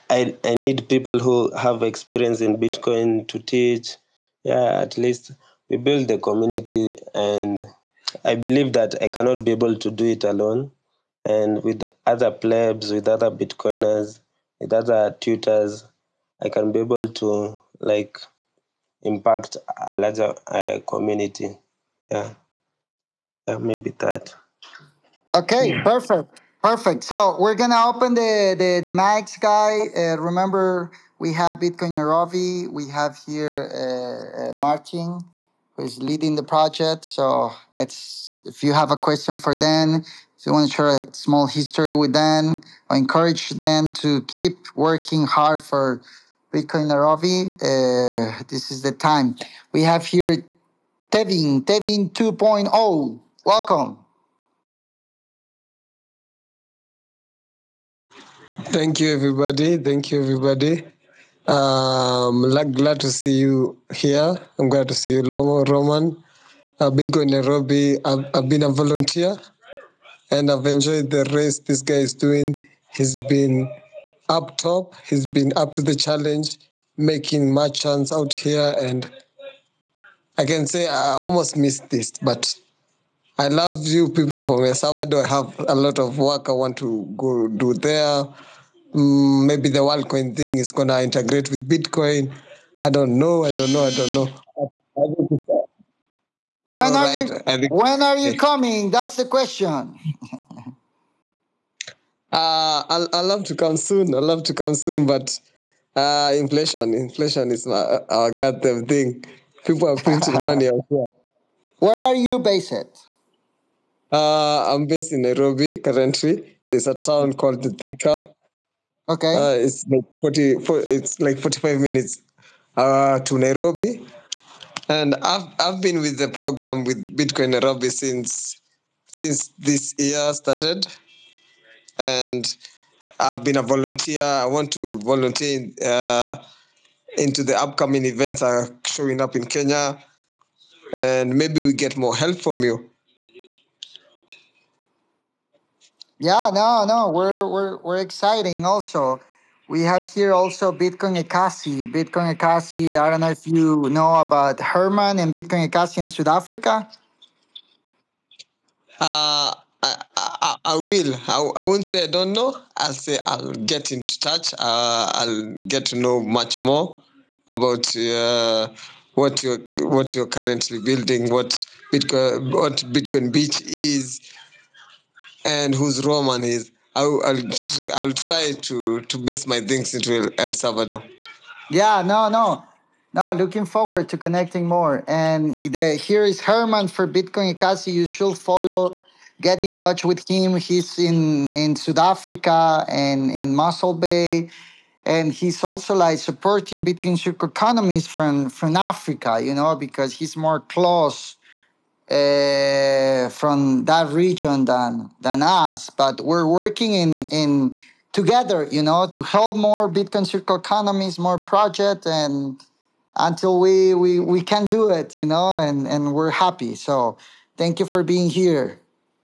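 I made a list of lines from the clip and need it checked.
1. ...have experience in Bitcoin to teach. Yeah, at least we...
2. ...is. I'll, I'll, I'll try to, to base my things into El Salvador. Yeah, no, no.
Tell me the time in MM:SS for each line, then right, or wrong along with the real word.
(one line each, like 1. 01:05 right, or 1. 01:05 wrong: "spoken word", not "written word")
1. 00:01 right
2. 02:56 right.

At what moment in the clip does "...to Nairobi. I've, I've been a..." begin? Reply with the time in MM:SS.
01:07.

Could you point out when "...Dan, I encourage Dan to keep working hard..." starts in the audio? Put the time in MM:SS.
00:42.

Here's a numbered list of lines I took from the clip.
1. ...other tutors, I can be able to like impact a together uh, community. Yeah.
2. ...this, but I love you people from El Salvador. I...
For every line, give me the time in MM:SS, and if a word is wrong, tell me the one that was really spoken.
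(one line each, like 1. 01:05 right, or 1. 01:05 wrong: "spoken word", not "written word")
1. 00:14 wrong: "larger", not "together"
2. 01:21 right.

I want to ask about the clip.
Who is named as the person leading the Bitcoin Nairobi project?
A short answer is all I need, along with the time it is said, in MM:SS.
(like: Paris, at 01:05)
Martin, at 00:34.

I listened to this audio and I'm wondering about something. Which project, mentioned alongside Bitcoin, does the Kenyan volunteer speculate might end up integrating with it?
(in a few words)
WorldCoin.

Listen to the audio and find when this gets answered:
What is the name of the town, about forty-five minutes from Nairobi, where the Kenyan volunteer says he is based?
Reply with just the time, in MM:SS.
01:57.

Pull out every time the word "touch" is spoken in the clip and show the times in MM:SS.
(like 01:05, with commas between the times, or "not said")
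02:44, 03:09.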